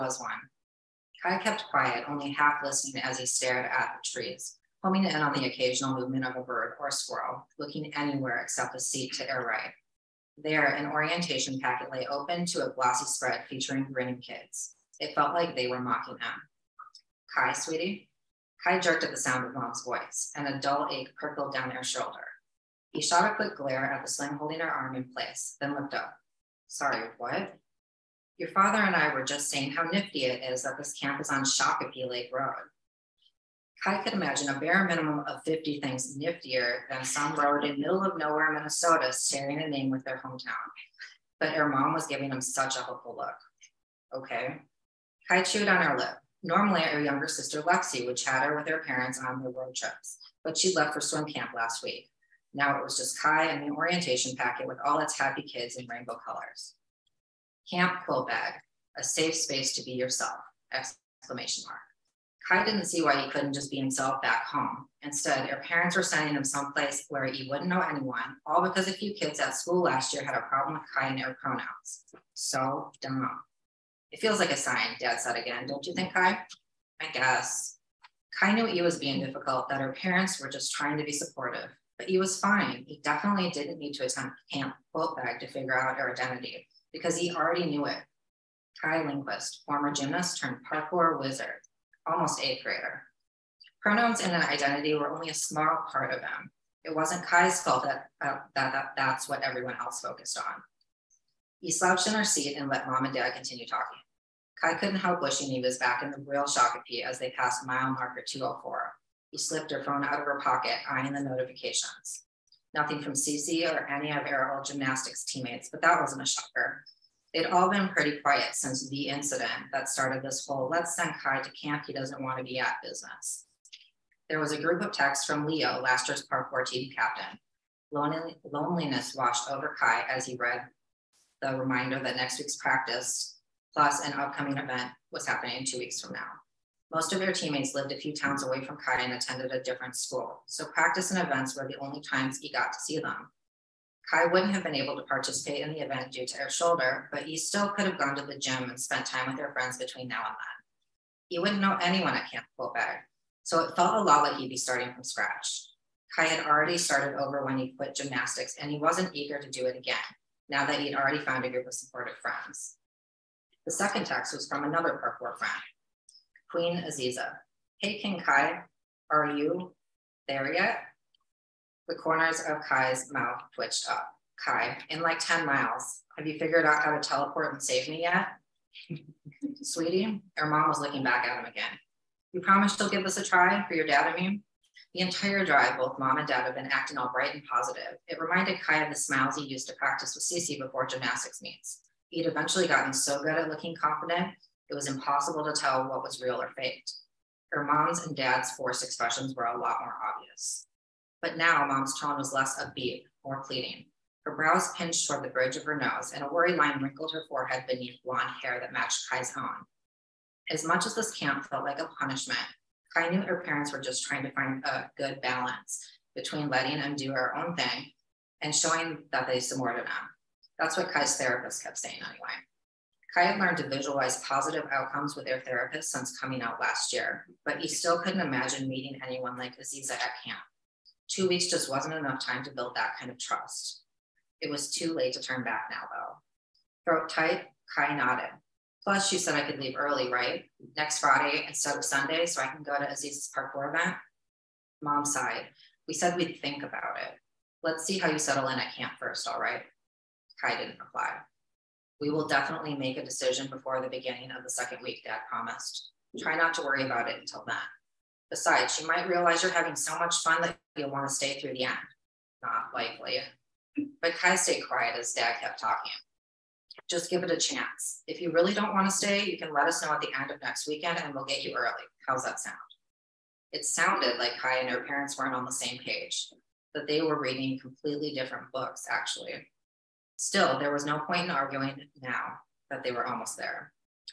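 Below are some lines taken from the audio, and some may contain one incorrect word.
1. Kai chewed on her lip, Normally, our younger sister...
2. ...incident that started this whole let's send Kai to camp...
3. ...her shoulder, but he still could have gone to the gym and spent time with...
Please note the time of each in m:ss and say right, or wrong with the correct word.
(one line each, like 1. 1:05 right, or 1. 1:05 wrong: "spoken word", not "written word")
1. 0:45 right
2. 1:59 right
3. 2:26 right.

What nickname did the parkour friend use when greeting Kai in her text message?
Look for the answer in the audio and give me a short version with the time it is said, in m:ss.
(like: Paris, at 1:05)
King Kai, at 2:47.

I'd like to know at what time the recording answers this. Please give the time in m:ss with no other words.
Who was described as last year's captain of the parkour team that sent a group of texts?
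2:05.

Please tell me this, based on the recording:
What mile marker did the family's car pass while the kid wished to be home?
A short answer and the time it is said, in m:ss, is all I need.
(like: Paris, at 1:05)
204, at 1:48.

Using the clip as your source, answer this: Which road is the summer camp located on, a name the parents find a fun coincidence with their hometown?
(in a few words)
Shakopee Lake Road.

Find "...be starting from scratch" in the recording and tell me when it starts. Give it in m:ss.
2:34.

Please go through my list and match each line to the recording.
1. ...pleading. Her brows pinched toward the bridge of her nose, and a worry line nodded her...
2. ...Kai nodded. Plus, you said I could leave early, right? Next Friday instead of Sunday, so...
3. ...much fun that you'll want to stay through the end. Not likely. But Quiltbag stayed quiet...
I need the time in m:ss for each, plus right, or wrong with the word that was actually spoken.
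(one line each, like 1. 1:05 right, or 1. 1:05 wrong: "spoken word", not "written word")
1. 3:23 wrong: "wrinkled", not "nodded"
2. 3:57 right
3. 4:19 wrong: "Kai", not "Quiltbag".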